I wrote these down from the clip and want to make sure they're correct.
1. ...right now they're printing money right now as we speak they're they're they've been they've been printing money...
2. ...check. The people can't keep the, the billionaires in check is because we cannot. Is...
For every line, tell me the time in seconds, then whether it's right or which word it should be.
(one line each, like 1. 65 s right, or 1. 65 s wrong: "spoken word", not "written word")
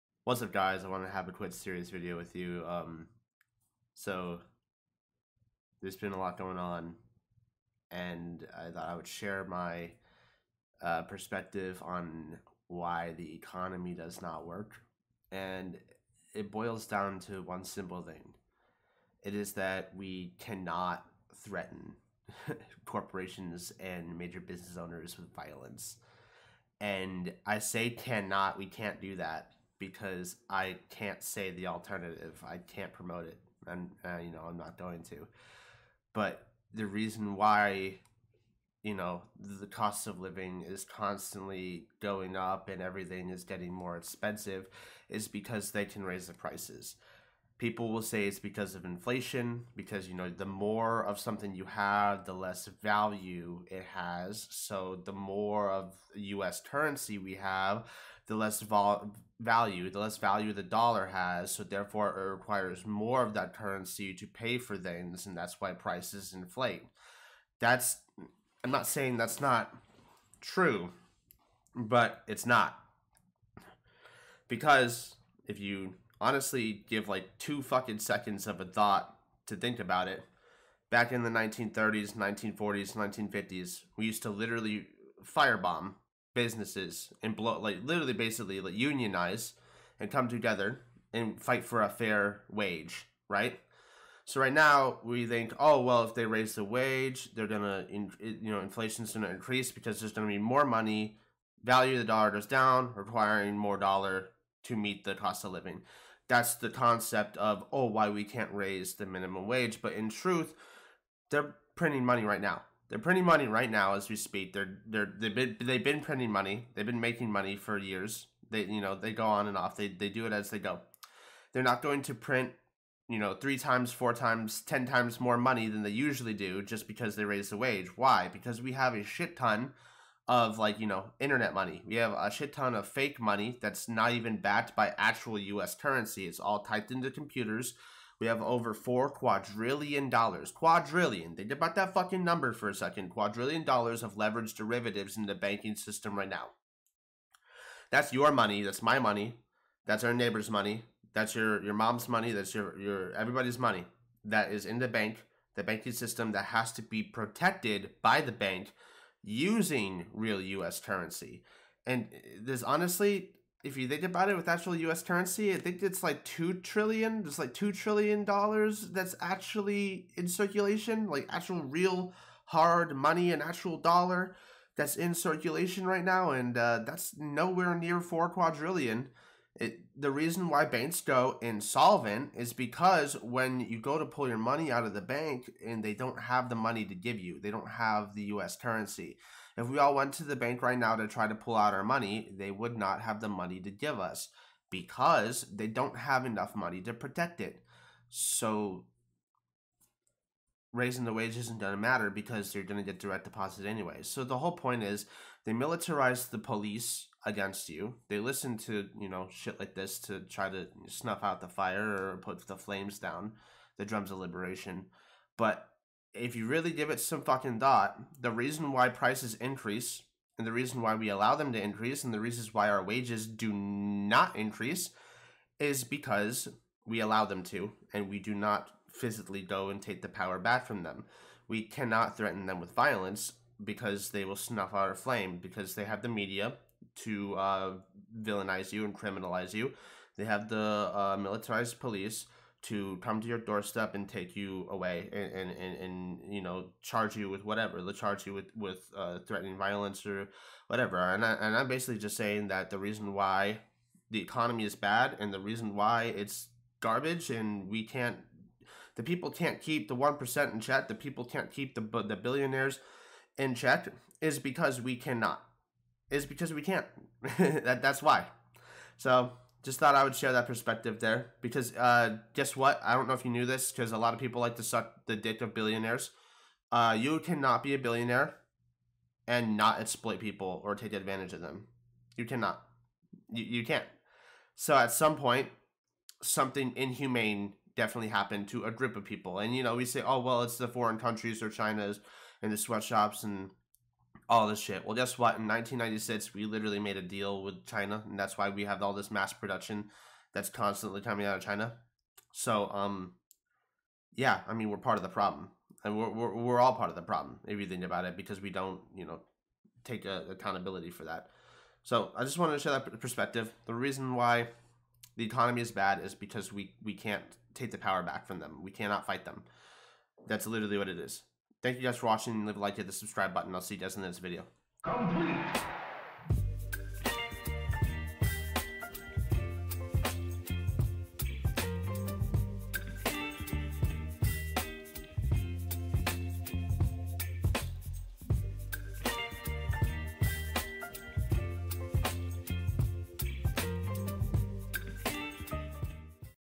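1. 112 s right
2. 260 s right.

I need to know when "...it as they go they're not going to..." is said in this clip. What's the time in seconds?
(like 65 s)
120 s.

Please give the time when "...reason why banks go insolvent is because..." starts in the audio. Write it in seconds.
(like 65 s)
180 s.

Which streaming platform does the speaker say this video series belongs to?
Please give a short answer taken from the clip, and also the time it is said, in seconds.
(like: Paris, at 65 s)
Twitch, at 1 s.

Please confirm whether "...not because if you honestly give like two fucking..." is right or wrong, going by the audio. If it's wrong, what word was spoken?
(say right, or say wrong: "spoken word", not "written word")
right.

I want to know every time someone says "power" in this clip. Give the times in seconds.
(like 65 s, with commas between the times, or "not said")
230 s, 317 s.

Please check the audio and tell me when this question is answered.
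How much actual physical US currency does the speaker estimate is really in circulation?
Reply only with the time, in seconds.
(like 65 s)
167 s.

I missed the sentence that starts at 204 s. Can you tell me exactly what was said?
So the whole point is they militarize the police against you.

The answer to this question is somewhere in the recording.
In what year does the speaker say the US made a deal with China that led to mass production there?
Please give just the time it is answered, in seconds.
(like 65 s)
295 s.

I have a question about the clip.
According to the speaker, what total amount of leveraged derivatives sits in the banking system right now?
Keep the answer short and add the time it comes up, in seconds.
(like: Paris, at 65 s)
4 quadrillion dollars, at 138 s.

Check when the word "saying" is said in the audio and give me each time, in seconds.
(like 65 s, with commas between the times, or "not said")
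68 s, 252 s.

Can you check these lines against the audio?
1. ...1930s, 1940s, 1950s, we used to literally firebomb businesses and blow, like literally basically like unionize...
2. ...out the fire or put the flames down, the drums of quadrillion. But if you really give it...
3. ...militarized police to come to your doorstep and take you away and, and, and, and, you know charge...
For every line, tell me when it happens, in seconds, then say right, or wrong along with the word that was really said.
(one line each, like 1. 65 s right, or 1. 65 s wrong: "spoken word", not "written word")
1. 81 s right
2. 211 s wrong: "liberation", not "quadrillion"
3. 241 s right.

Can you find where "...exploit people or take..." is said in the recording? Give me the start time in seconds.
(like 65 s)
279 s.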